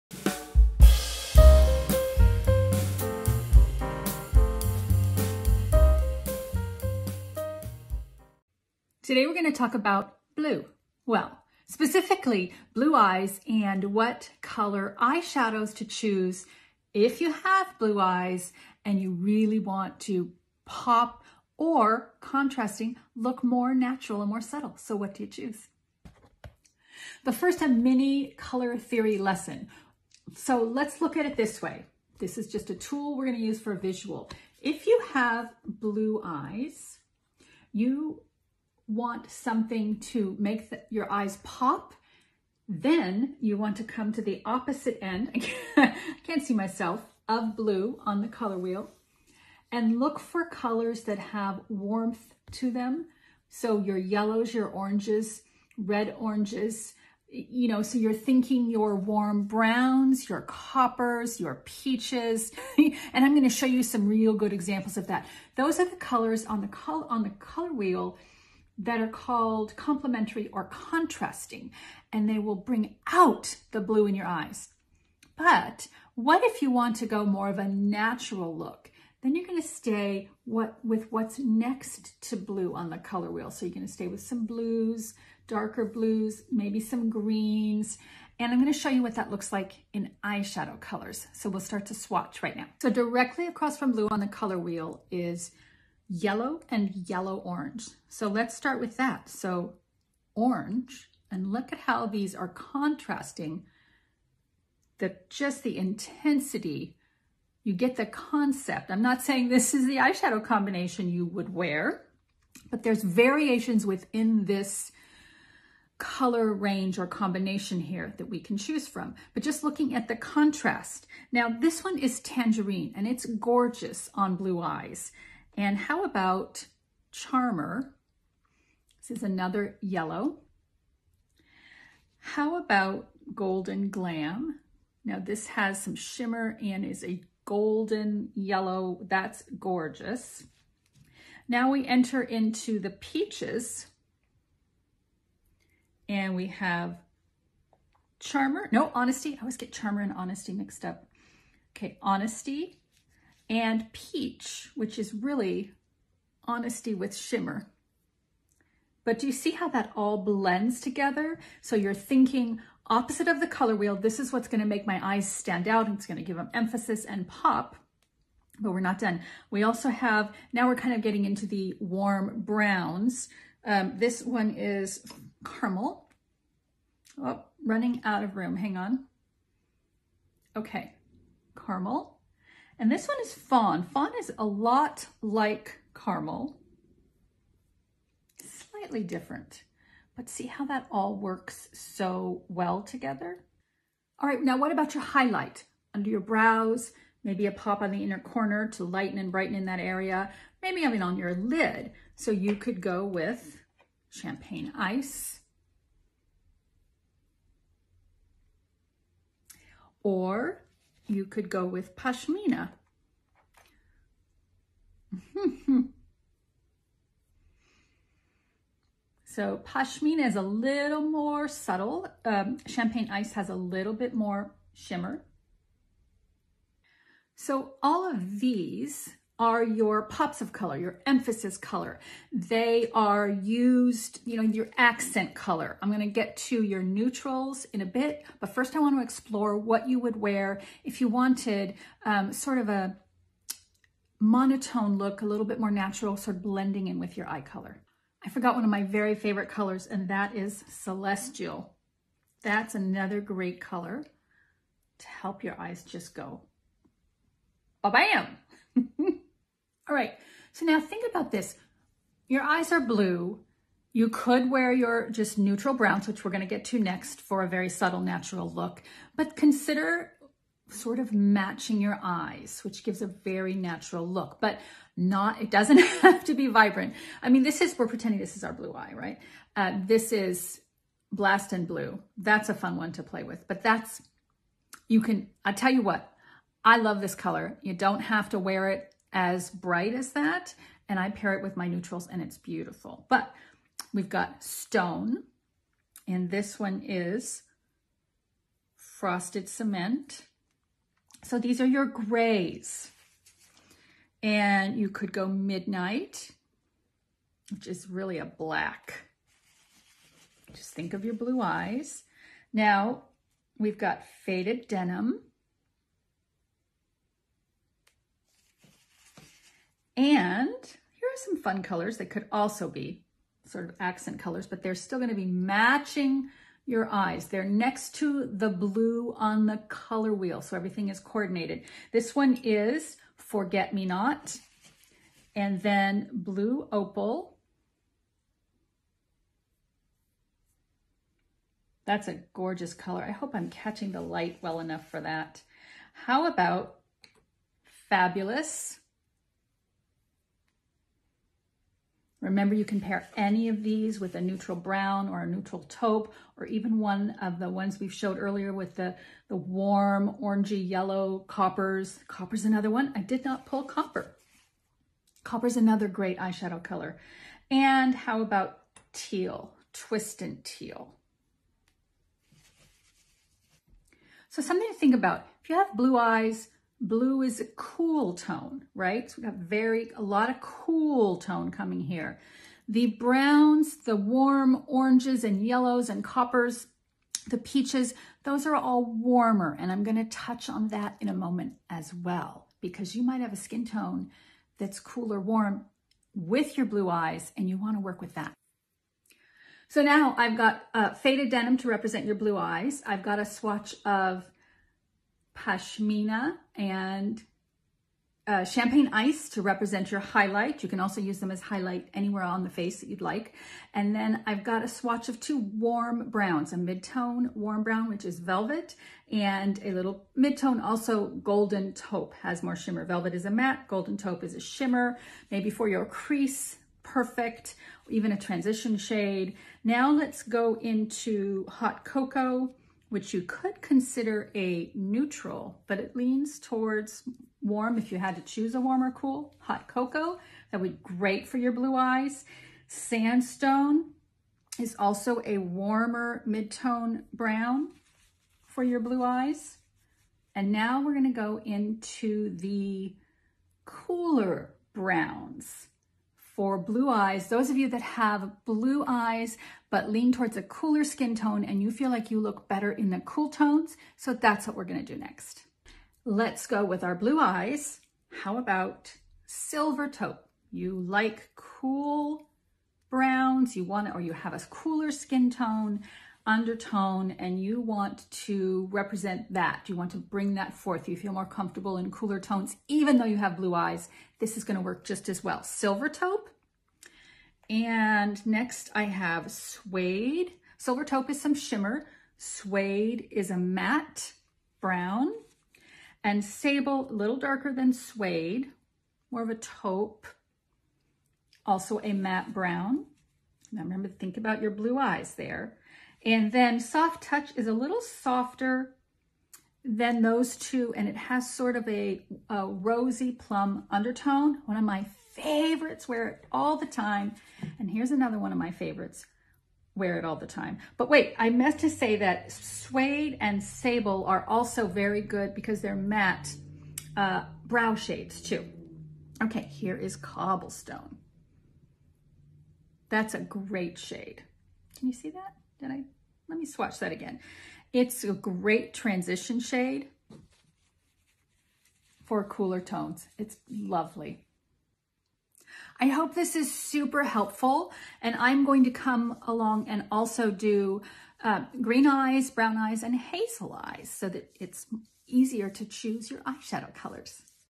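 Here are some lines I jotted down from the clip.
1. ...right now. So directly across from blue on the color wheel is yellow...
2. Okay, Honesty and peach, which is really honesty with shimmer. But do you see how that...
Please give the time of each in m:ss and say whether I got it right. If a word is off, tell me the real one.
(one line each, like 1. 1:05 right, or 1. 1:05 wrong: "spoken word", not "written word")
1. 1:32 right
2. 2:31 right.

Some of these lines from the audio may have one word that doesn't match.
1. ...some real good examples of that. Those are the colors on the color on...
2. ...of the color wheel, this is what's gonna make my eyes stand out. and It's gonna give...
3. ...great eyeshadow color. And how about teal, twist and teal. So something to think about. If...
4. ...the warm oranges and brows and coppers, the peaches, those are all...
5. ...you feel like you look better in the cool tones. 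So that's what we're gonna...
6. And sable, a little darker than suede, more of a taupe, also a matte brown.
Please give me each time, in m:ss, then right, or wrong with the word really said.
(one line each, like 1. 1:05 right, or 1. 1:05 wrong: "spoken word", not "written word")
1. 1:03 right
2. 2:43 right
3. 6:05 right
4. 6:23 wrong: "yellows", not "brows"
5. 7:41 right
6. 8:16 right.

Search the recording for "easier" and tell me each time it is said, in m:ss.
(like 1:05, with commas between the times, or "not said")
9:15.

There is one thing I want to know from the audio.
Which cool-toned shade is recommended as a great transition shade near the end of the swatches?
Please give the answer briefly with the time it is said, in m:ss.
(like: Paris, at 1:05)
Cobblestone, at 8:49.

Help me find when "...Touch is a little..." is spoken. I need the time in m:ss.
8:27.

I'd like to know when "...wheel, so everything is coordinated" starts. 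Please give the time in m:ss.
5:30.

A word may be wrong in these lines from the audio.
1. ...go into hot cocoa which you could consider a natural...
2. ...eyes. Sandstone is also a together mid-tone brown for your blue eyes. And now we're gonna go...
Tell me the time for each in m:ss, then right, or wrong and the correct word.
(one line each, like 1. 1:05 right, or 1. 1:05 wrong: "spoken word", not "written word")
1. 7:10 wrong: "neutral", not "natural"
2. 7:21 wrong: "warmer", not "together".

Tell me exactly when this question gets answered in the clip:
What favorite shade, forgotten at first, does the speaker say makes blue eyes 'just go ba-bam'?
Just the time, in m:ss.
4:10.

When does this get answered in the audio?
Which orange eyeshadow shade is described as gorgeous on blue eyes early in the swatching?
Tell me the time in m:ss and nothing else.
2:02.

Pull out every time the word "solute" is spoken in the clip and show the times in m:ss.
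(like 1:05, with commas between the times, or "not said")
not said.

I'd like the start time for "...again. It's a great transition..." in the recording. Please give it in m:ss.
8:56.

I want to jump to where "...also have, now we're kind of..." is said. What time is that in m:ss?
2:49.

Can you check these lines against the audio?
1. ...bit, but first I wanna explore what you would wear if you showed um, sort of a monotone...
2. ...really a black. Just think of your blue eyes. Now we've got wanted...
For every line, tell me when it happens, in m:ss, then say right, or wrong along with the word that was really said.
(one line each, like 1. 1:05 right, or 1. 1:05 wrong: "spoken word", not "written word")
1. 3:57 wrong: "wanted", not "showed"
2. 5:07 wrong: "faded", not "wanted".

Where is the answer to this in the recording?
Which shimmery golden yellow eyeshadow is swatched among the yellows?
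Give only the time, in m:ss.
2:13.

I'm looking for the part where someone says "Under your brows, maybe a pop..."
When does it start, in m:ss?
3:15.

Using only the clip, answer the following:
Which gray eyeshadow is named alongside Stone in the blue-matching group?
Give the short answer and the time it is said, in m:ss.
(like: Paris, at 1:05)
Frosted Cement, at 4:58.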